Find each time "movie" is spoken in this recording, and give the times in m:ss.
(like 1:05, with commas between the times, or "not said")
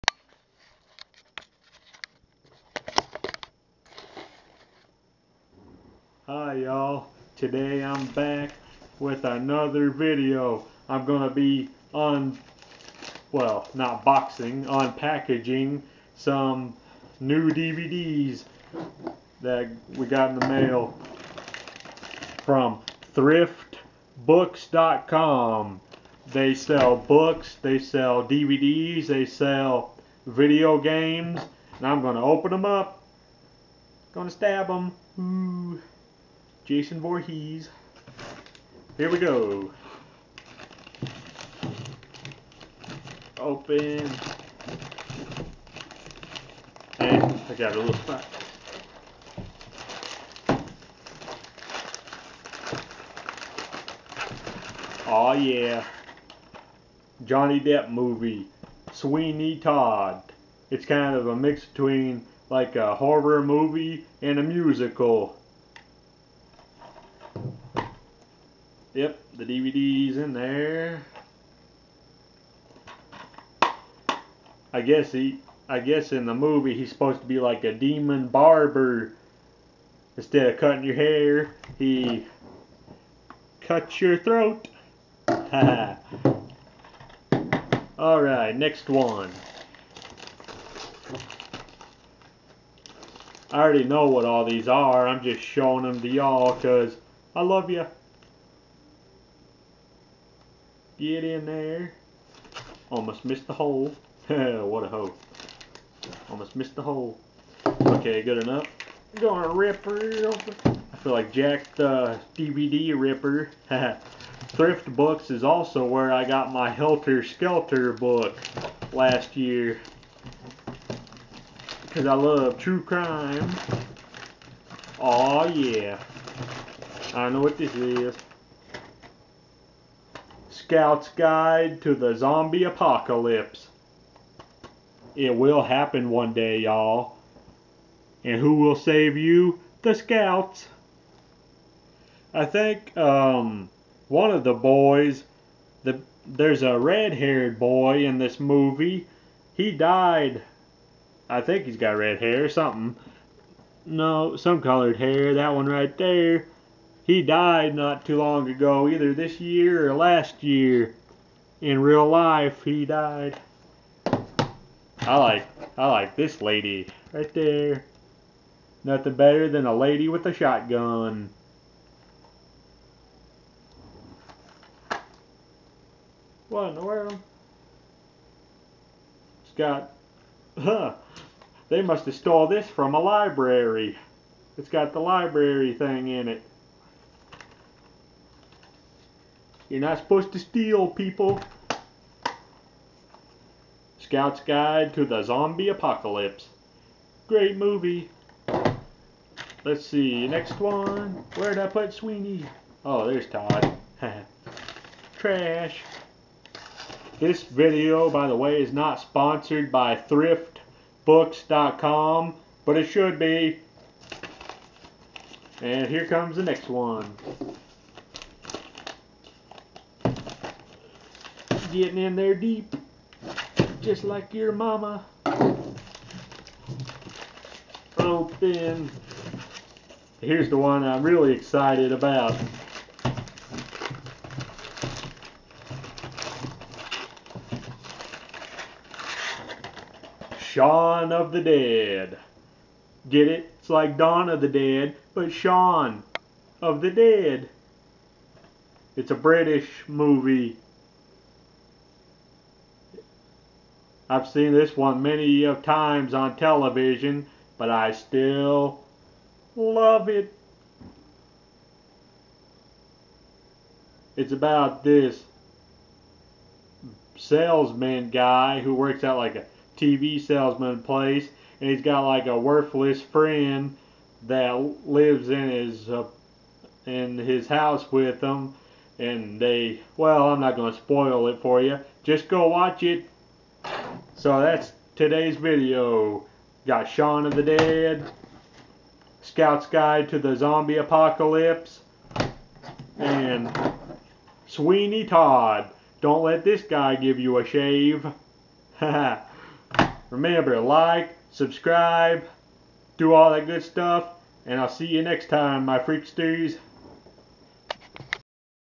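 0:57, 1:03, 1:16, 2:28, 3:17, 4:09.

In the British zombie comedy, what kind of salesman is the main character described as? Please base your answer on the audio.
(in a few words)
TV salesman.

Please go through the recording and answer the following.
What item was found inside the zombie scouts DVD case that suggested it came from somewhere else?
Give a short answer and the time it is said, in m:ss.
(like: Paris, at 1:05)
library thing, at 3:05.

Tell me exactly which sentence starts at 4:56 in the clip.
Don't let this guy give you a shave.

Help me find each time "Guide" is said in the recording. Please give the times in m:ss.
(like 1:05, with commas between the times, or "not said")
2:11, 3:14, 4:49.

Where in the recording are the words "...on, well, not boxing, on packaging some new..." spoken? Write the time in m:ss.
0:11.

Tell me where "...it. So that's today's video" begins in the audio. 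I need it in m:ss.
4:42.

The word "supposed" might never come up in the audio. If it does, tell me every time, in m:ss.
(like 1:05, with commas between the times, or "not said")
1:16, 3:09.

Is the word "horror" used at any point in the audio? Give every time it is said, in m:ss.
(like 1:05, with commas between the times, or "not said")
1:02.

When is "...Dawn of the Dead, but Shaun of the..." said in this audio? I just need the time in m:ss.
4:03.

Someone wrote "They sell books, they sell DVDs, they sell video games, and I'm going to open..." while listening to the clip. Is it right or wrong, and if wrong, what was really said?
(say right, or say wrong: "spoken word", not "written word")
right.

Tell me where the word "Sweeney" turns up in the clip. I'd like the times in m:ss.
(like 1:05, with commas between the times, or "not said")
0:58, 3:21, 4:54.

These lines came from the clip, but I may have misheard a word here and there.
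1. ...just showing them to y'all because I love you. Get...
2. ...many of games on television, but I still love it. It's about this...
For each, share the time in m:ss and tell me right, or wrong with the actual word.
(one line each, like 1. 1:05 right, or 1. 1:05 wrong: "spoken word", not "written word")
1. 1:35 right
2. 4:15 wrong: "times", not "games".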